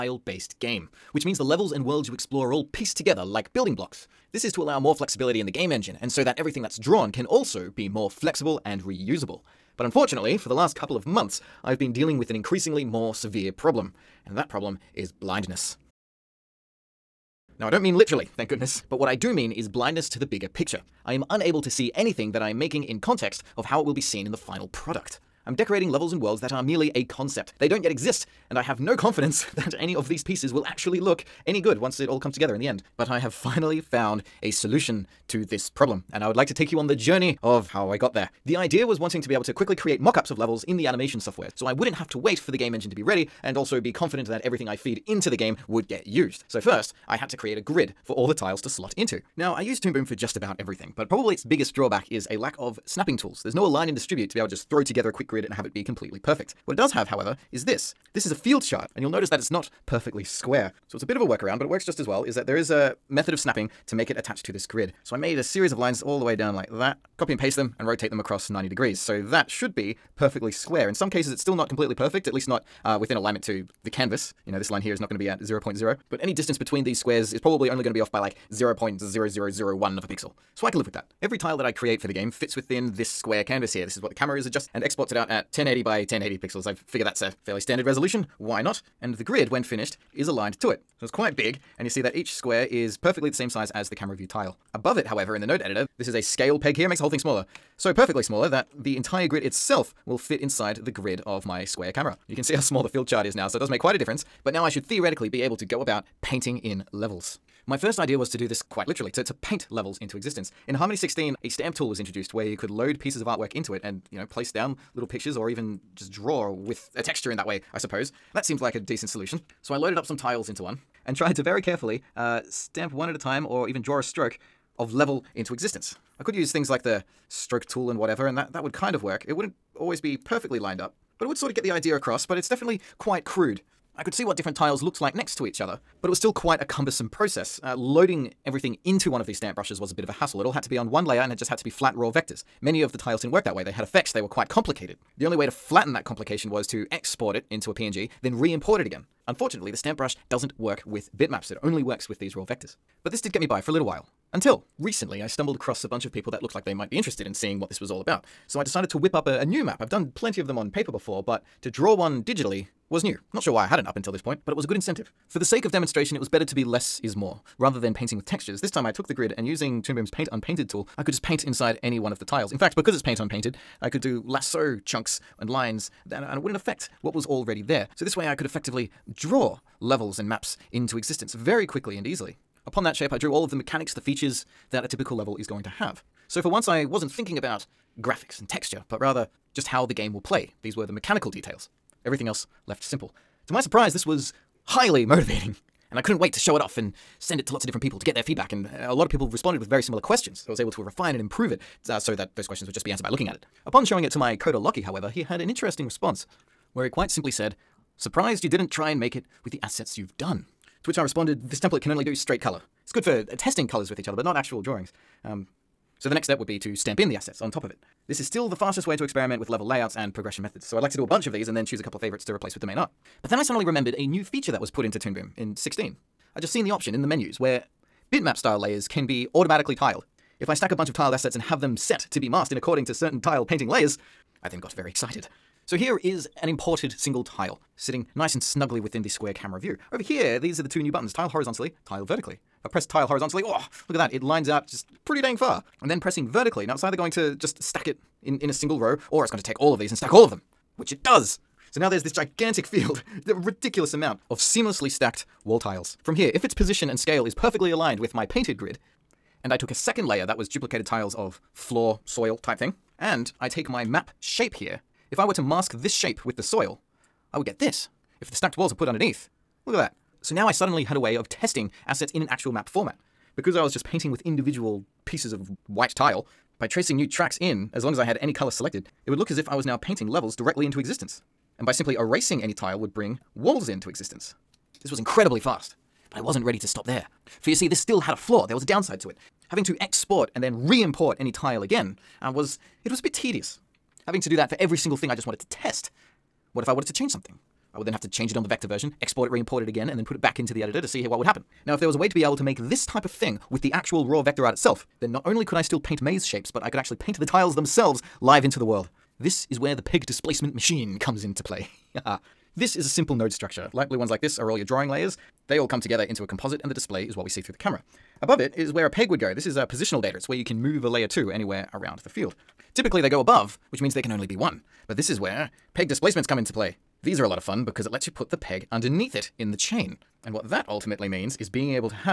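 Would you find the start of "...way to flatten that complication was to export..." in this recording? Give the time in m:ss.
2:25.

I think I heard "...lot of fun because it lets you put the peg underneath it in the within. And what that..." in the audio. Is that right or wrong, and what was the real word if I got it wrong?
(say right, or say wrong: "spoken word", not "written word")
wrong: "chain", not "within".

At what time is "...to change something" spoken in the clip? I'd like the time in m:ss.
4:56.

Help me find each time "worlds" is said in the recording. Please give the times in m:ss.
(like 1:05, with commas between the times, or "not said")
0:01, 0:26, 5:08.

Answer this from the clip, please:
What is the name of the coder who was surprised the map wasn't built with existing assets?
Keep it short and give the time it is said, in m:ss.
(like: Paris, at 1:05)
Lockie, at 3:24.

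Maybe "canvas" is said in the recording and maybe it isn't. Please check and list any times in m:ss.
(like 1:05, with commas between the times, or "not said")
1:13, 1:23.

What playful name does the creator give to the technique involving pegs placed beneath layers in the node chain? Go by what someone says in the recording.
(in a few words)
peg displacement machine.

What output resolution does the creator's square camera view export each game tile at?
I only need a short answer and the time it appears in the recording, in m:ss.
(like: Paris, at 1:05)
1080 by 1080 pixels, at 1:25.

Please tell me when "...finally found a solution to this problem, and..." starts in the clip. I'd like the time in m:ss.
0:33.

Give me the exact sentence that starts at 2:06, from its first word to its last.
I could use things like the stroke tool and whatever, and that, that would kind of work.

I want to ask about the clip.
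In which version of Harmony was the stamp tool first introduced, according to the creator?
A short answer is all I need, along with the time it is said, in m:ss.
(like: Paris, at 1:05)
16, at 1:50.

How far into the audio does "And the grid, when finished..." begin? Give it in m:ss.
1:28.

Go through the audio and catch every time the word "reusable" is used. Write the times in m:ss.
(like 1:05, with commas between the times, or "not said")
0:08.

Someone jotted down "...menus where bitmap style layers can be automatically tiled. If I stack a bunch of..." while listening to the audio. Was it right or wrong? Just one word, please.
right.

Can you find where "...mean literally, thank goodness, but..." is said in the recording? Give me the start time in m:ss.
0:17.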